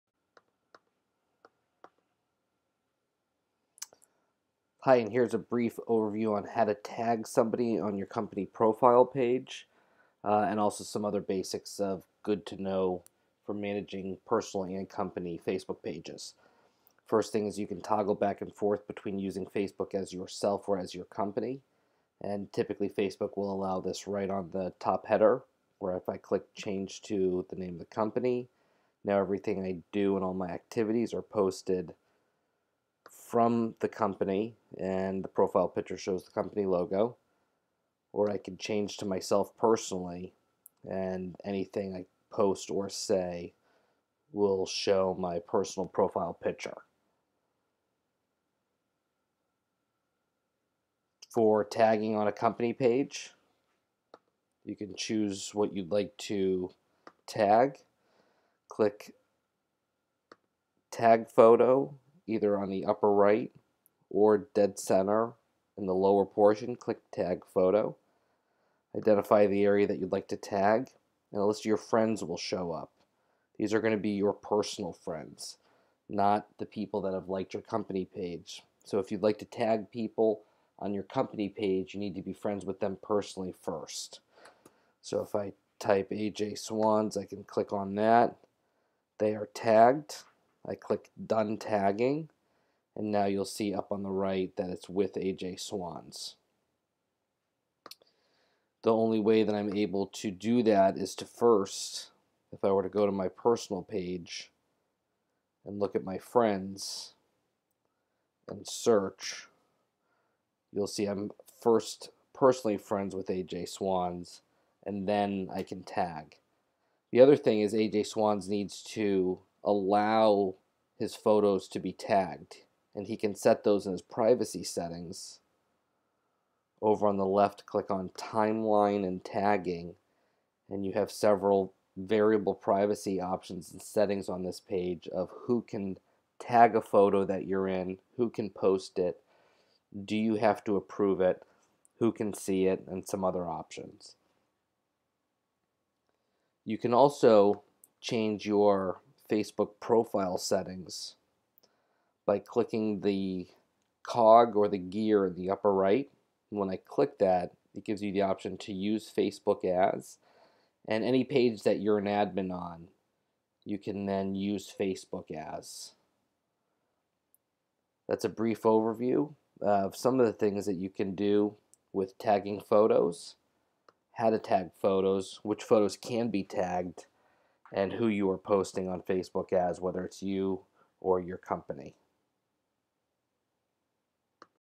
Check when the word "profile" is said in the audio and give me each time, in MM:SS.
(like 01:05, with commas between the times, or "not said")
00:08, 00:35, 00:45, 02:29.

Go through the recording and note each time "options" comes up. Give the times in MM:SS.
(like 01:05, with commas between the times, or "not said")
02:13, 02:23, 02:38.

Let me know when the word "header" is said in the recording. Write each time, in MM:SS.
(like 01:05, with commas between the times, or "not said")
00:25.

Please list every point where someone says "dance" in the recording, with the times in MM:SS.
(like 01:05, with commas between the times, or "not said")
not said.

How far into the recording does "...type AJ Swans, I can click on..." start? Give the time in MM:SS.
01:25.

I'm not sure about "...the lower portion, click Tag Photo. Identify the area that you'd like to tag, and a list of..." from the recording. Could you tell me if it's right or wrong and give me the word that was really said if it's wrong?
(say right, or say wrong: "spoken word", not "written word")
right.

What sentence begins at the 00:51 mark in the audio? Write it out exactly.
For tagging on a company page, you can choose what you'd like to tag.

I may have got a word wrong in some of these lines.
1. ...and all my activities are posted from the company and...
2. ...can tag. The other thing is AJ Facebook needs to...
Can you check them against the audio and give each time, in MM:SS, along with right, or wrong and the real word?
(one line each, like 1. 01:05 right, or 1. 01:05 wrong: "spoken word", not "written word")
1. 00:30 right
2. 01:55 wrong: "Swans", not "Facebook".